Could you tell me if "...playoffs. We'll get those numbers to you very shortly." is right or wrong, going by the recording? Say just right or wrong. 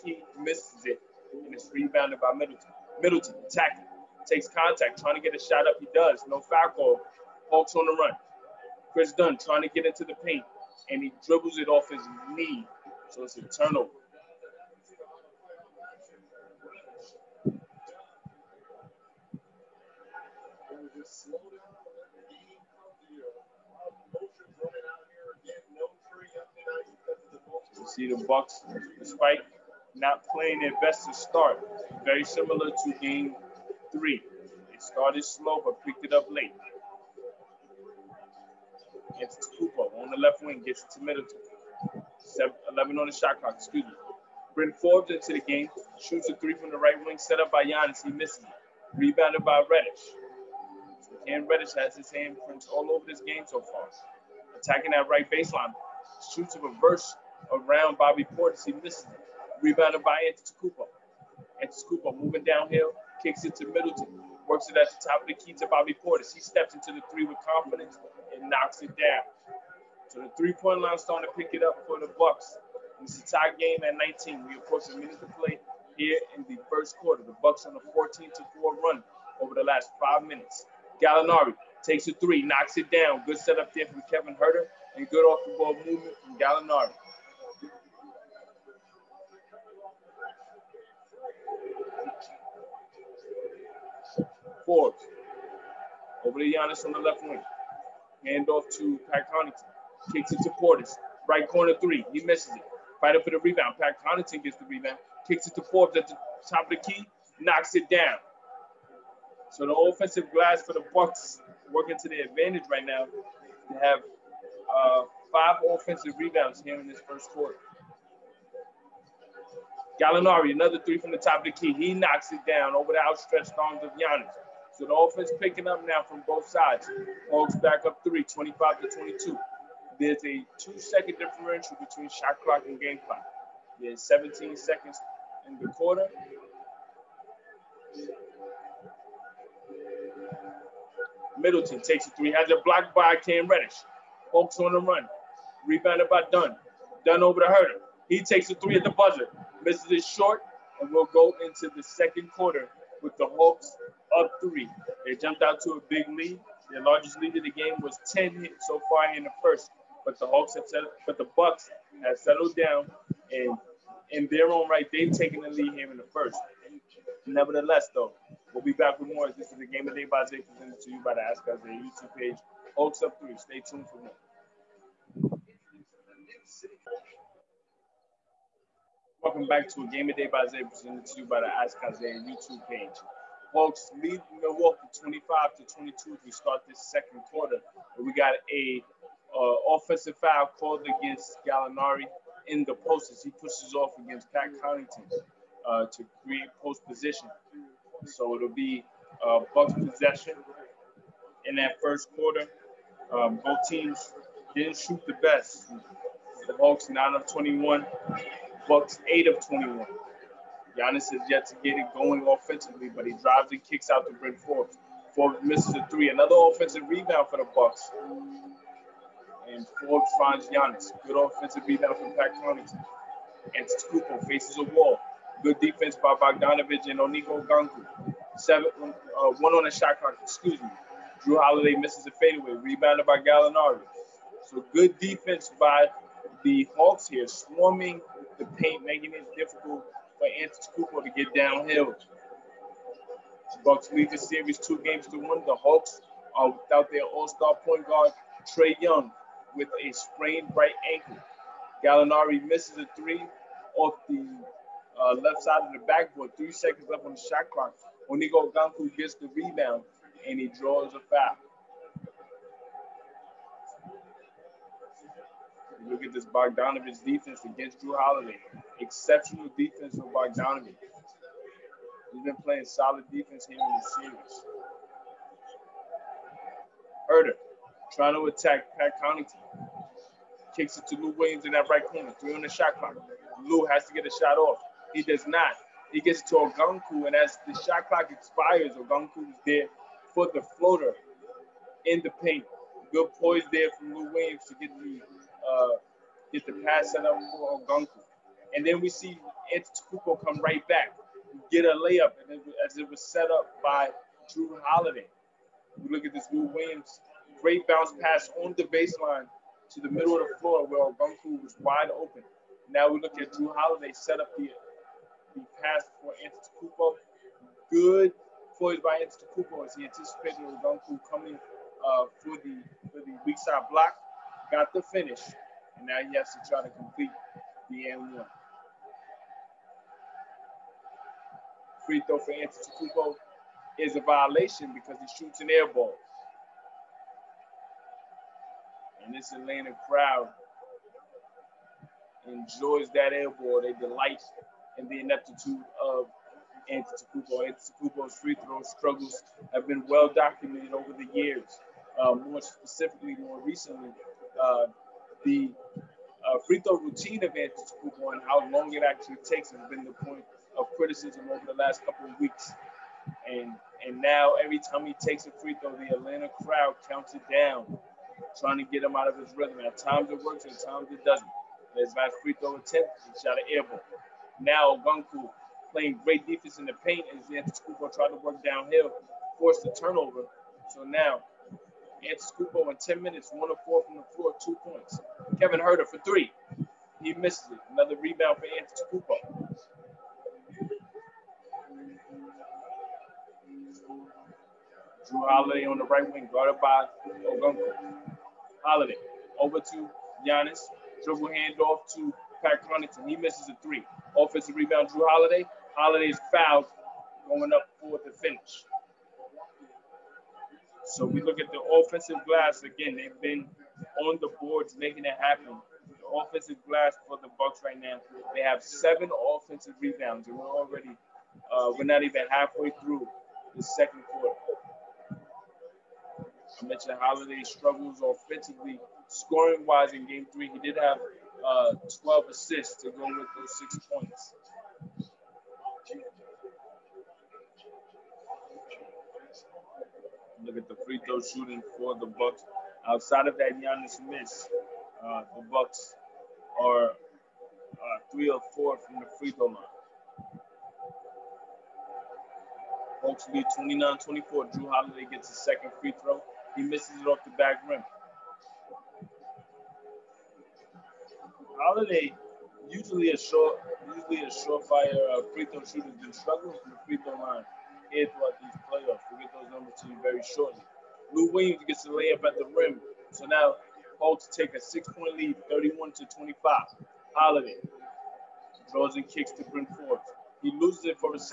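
right.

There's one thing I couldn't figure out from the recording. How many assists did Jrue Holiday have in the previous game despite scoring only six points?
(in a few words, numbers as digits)
12.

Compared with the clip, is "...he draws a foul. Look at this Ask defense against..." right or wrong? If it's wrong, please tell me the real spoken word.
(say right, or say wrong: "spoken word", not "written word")
wrong: "Bogdanovich", not "Ask".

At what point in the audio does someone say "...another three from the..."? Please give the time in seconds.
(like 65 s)
120 s.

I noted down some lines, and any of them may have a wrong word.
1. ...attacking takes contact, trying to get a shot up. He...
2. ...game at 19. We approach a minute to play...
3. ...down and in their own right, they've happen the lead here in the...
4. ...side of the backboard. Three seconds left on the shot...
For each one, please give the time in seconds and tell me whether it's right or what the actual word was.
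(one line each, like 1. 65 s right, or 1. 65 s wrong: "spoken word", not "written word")
1. 3 s right
2. 73 s right
3. 162 s wrong: "taken", not "happen"
4. 255 s right.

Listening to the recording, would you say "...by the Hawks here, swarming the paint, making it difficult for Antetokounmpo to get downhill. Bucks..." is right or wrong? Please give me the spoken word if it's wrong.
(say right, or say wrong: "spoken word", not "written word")
right.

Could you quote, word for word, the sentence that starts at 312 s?
Now we look at Jrue Holiday set up the, the pass for Antetokounmpo.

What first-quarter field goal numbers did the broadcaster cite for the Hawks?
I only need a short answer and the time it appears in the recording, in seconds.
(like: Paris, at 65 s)
9 of 21, at 206 s.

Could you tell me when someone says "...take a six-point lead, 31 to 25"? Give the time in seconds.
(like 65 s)
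474 s.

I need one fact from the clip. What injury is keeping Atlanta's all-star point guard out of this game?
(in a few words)
Sprained right ankle.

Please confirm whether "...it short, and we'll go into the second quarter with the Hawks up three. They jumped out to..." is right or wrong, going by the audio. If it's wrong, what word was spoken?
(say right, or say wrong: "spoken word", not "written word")
right.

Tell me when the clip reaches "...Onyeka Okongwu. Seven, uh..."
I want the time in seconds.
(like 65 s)
226 s.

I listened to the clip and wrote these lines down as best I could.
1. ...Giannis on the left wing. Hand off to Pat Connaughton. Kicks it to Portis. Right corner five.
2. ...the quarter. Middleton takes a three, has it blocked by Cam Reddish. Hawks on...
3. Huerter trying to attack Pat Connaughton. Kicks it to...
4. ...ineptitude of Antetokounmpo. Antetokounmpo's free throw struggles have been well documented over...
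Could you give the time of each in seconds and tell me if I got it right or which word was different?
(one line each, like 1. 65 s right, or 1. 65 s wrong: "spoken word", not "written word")
1. 96 s wrong: "three", not "five"
2. 135 s right
3. 277 s right
4. 345 s right.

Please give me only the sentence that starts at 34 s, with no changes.
It started slow but picked it up late.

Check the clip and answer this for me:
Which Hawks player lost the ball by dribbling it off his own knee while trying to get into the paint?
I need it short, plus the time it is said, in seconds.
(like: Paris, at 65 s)
Kris Dunn, at 8 s.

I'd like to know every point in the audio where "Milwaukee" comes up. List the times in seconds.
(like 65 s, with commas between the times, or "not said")
184 s.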